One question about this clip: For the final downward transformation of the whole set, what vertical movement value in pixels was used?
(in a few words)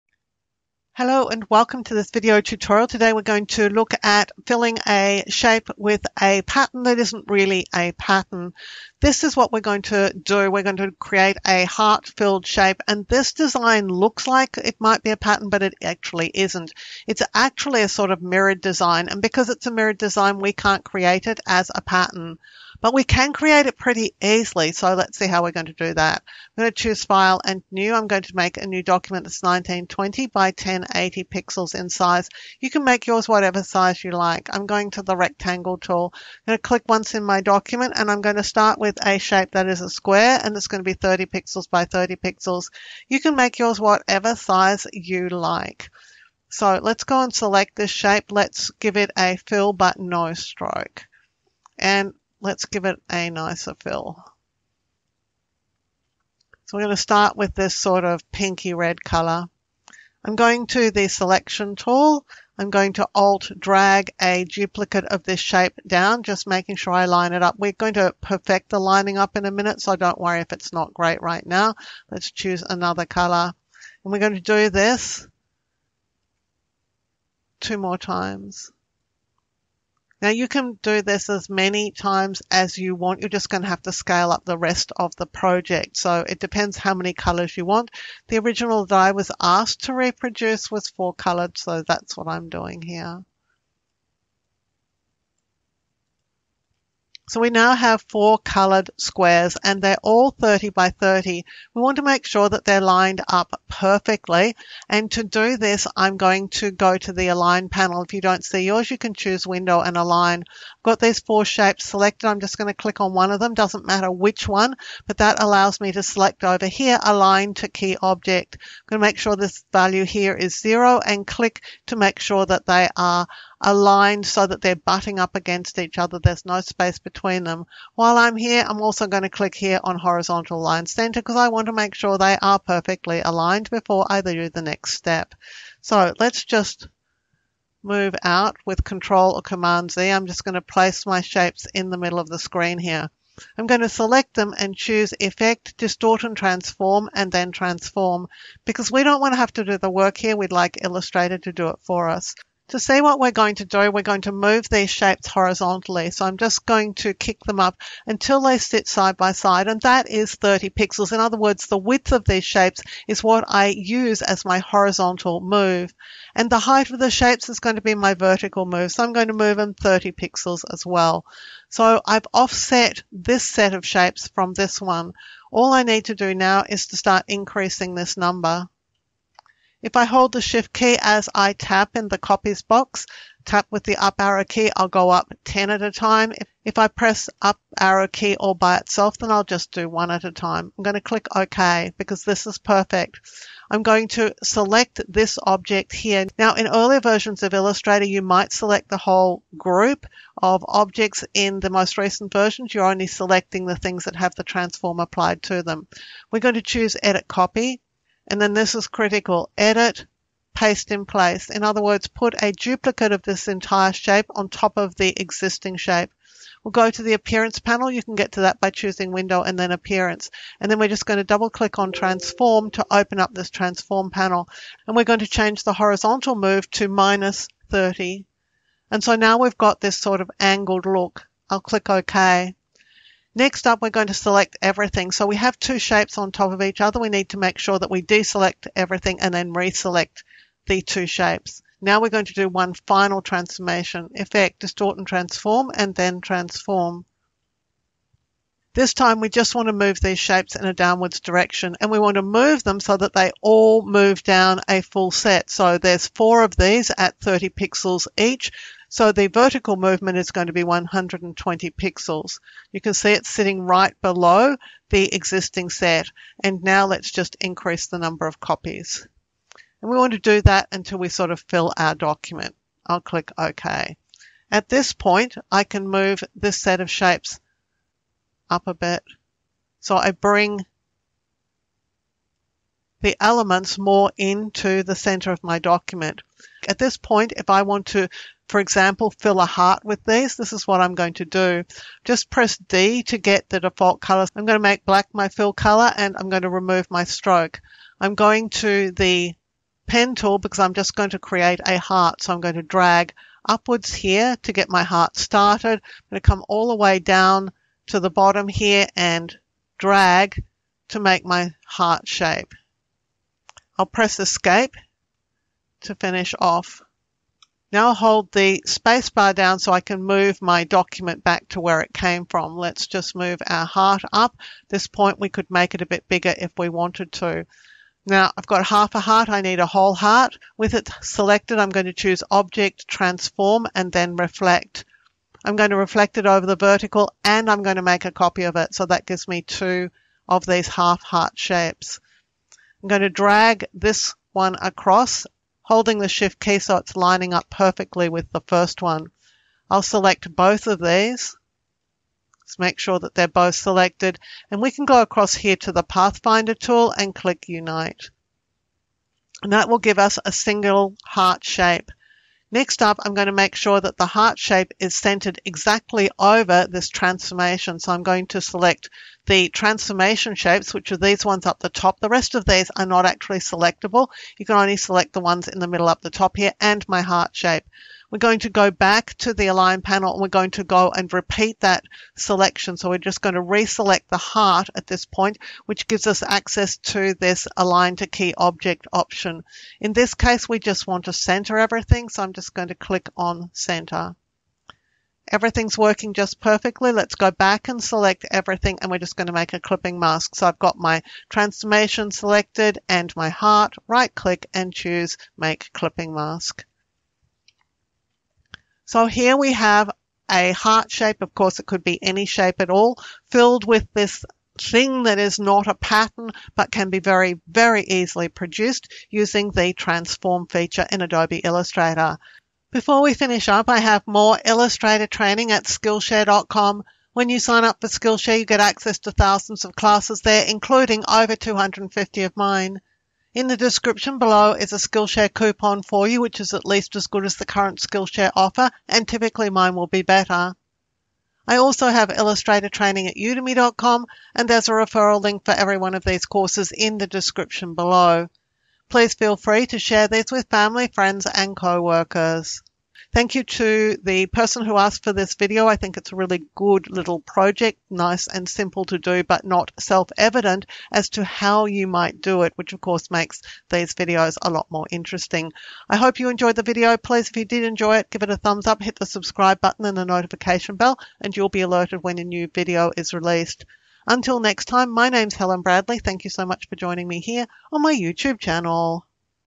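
120.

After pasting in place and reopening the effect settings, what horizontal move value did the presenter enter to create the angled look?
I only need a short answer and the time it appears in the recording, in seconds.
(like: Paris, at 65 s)
-30, at 226 s.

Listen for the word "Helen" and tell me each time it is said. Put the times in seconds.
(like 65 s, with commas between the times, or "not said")
475 s.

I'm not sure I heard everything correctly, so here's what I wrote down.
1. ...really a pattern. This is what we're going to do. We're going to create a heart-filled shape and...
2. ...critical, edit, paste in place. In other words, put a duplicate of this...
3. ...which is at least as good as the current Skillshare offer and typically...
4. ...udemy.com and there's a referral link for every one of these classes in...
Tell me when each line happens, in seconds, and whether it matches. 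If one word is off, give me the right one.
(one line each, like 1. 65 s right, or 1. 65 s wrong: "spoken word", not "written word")
1. 7 s right
2. 208 s right
3. 436 s right
4. 443 s wrong: "courses", not "classes".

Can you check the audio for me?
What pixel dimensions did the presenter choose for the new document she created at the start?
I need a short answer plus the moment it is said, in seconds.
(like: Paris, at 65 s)
1920 by 1080, at 29 s.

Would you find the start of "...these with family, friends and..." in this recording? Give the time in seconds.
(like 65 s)
450 s.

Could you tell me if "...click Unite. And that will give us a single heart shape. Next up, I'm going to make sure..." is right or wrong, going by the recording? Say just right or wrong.
right.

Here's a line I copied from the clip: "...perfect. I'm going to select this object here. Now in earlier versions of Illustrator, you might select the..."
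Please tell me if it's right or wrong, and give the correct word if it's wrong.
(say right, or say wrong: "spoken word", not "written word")
right.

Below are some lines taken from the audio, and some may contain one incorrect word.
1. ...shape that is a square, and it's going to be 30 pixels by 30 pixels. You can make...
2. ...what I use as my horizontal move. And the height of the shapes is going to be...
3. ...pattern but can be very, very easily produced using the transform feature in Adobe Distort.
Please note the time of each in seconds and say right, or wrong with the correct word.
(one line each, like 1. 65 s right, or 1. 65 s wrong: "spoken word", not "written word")
1. 39 s right
2. 163 s right
3. 415 s wrong: "Illustrator", not "Distort".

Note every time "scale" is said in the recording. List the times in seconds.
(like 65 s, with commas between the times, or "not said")
83 s.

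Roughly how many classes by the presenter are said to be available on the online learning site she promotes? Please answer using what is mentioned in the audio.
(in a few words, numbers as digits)
over 250.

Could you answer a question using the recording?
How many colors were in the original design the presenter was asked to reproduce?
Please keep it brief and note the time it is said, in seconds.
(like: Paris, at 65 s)
4, at 90 s.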